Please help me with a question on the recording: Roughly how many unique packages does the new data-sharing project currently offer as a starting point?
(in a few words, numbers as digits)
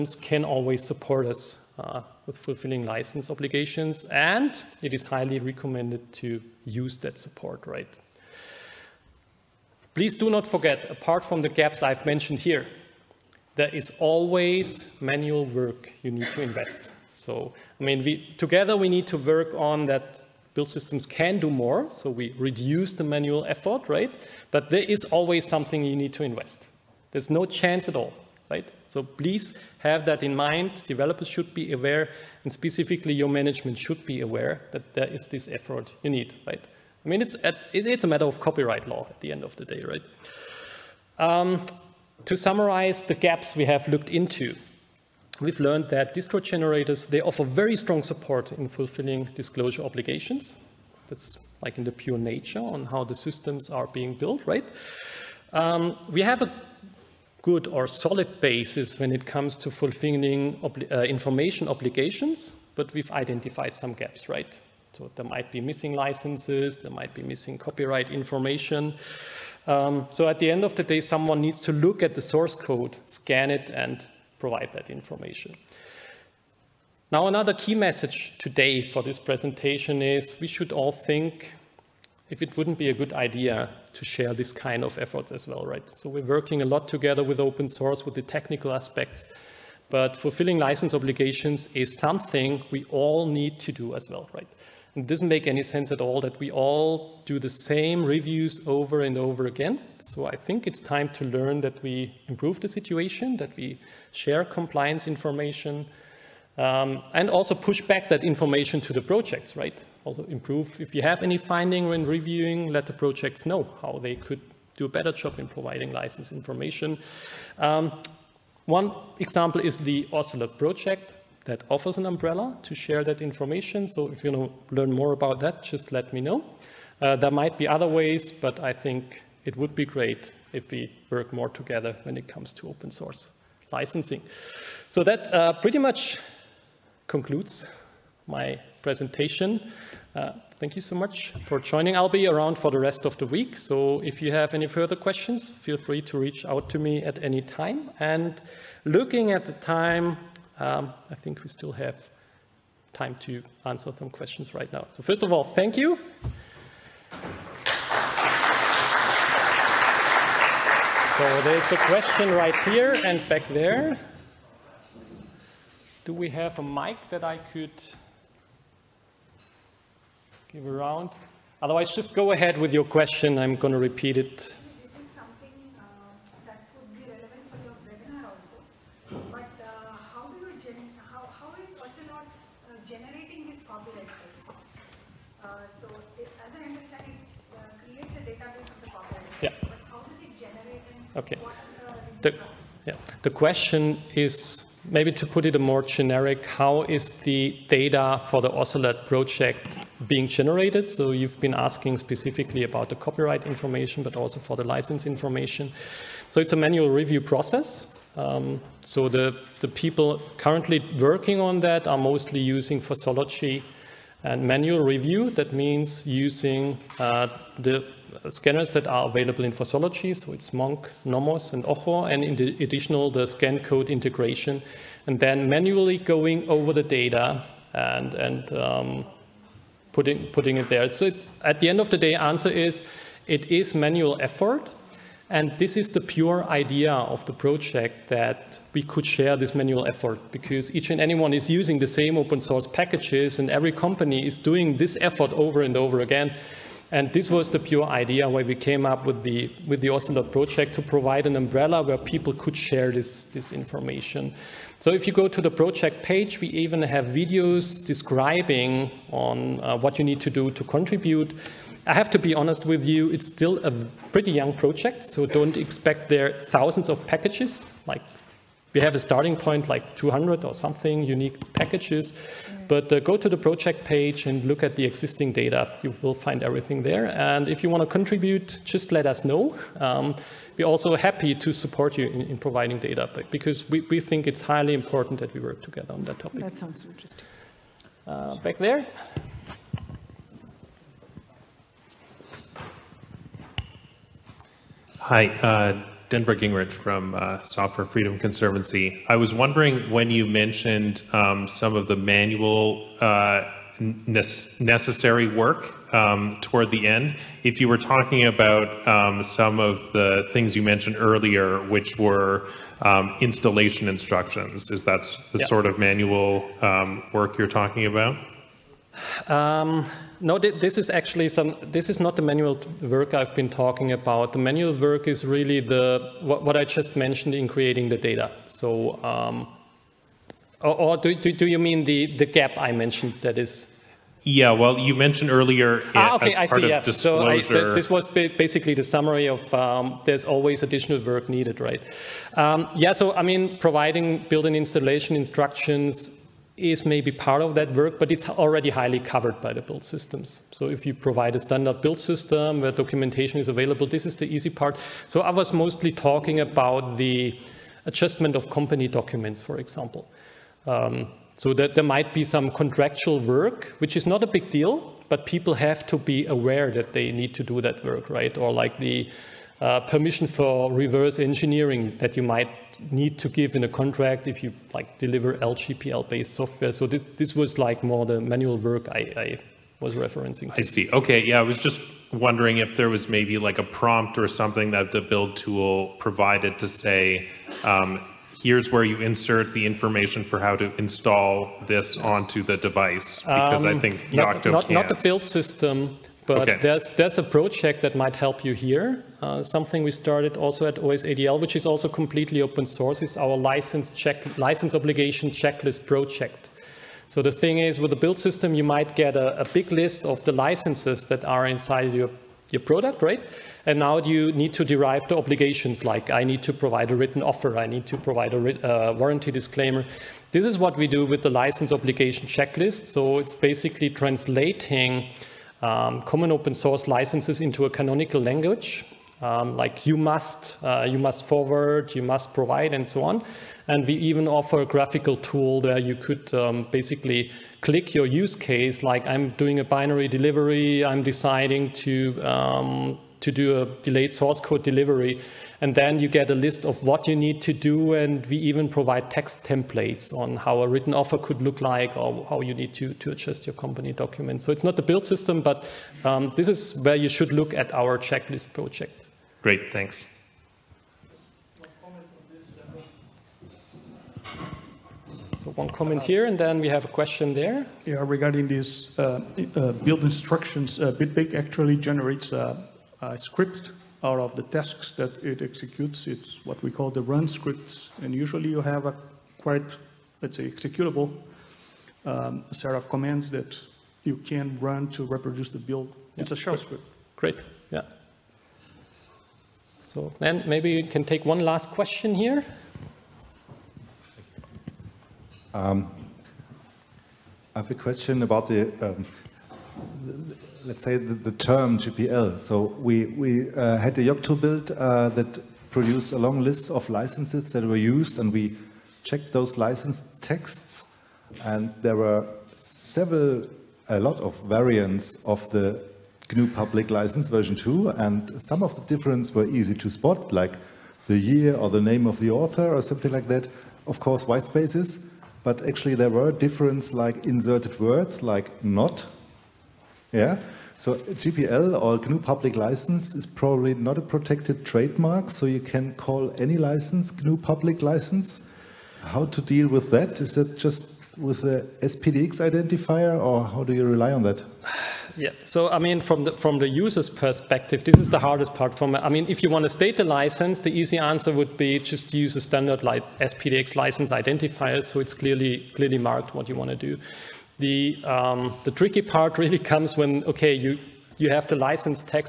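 200.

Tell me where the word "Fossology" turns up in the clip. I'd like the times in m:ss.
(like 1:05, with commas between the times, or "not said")
3:32, 3:39.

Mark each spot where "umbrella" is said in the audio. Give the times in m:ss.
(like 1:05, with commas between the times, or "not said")
2:02, 4:11.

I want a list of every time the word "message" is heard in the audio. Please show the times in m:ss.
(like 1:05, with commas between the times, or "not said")
1:17.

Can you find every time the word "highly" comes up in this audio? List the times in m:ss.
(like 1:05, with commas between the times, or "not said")
0:05, 4:44, 5:48.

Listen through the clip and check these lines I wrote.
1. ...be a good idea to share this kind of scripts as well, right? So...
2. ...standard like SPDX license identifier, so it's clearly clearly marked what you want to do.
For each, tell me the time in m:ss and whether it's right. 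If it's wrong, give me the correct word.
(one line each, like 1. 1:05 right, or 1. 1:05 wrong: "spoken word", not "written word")
1. 1:22 wrong: "efforts", not "scripts"
2. 9:12 right.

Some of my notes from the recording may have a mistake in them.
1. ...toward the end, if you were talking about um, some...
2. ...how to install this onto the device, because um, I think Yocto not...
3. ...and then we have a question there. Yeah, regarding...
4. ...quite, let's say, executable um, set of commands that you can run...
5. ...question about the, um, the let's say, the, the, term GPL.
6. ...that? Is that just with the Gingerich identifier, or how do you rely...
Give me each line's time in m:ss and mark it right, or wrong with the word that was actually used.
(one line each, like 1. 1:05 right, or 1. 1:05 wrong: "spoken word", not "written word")
1. 5:06 right
2. 6:30 right
3. 7:46 right
4. 7:59 right
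5. 8:17 right
6. 8:59 wrong: "SPDX", not "Gingerich".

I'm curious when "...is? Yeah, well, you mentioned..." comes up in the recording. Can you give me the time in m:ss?
5:33.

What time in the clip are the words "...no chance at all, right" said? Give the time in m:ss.
0:27.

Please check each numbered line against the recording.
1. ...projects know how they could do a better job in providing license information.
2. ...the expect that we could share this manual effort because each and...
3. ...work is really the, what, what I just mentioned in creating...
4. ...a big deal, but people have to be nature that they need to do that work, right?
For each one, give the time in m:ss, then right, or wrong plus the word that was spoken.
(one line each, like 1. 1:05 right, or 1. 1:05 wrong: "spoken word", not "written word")
1. 1:52 right
2. 3:57 wrong: "project", not "expect"
3. 5:24 right
4. 6:04 wrong: "aware", not "nature".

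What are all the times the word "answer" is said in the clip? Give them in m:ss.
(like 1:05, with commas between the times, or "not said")
2:33, 3:52, 9:10.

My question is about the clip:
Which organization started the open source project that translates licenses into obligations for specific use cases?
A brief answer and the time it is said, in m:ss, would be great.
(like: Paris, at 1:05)
OSADL, at 6:40.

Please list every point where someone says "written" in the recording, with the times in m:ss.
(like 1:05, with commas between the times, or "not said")
6:56, 7:30.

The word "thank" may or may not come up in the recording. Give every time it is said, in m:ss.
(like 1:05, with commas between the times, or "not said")
2:20, 2:35, 7:39.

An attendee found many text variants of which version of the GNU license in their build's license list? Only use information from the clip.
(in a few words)
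version 2.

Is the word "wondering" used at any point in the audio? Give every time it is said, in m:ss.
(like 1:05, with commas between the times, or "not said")
4:59, 6:22.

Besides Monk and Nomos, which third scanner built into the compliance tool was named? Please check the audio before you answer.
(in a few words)
Ojo.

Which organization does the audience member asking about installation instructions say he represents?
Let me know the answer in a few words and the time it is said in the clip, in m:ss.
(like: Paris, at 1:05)
Software Freedom Conservancy, at 4:57.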